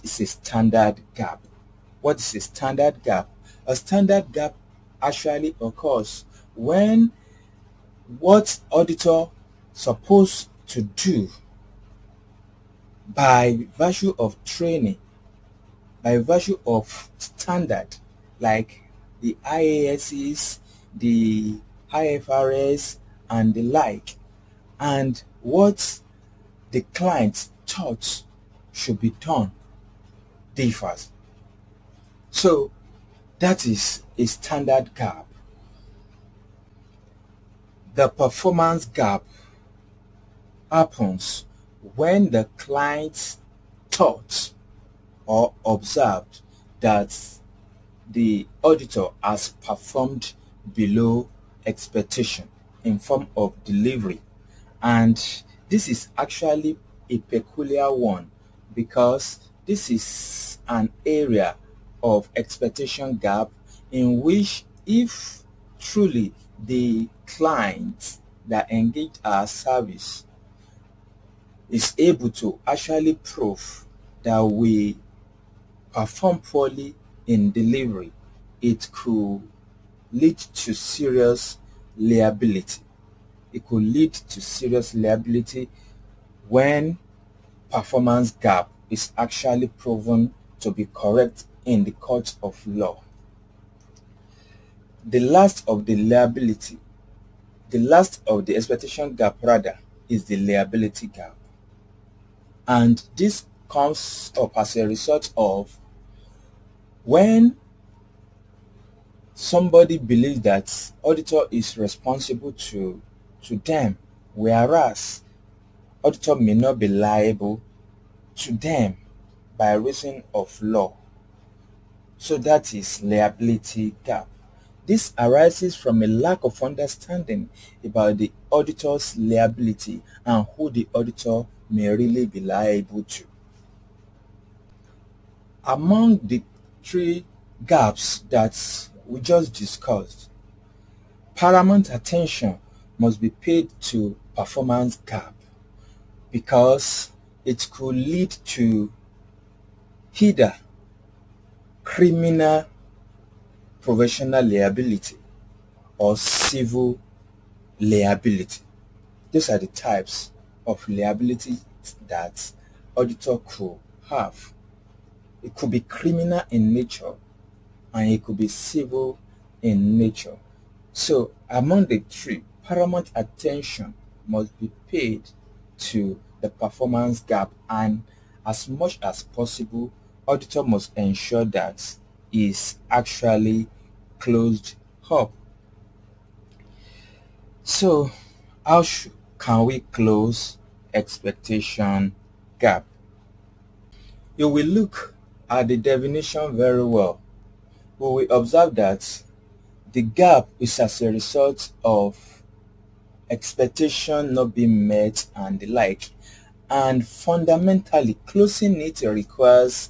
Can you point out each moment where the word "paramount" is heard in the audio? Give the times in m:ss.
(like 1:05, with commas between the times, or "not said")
2:21, 2:52.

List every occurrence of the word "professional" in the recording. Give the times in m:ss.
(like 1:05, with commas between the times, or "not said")
2:33.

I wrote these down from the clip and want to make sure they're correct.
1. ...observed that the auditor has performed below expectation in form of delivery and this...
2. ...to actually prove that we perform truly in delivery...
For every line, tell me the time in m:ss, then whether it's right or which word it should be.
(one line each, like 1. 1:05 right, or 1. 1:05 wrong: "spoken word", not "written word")
1. 0:45 right
2. 1:12 wrong: "poorly", not "truly".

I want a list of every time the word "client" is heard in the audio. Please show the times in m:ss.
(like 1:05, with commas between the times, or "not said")
0:26, 0:42, 1:07.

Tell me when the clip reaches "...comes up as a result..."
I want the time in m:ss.
1:43.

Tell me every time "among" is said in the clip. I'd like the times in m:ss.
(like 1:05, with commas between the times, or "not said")
2:15, 2:51.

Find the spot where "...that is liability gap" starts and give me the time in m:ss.
2:02.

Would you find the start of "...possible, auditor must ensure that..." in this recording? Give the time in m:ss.
2:59.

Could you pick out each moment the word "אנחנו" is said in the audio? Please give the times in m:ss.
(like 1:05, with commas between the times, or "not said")
not said.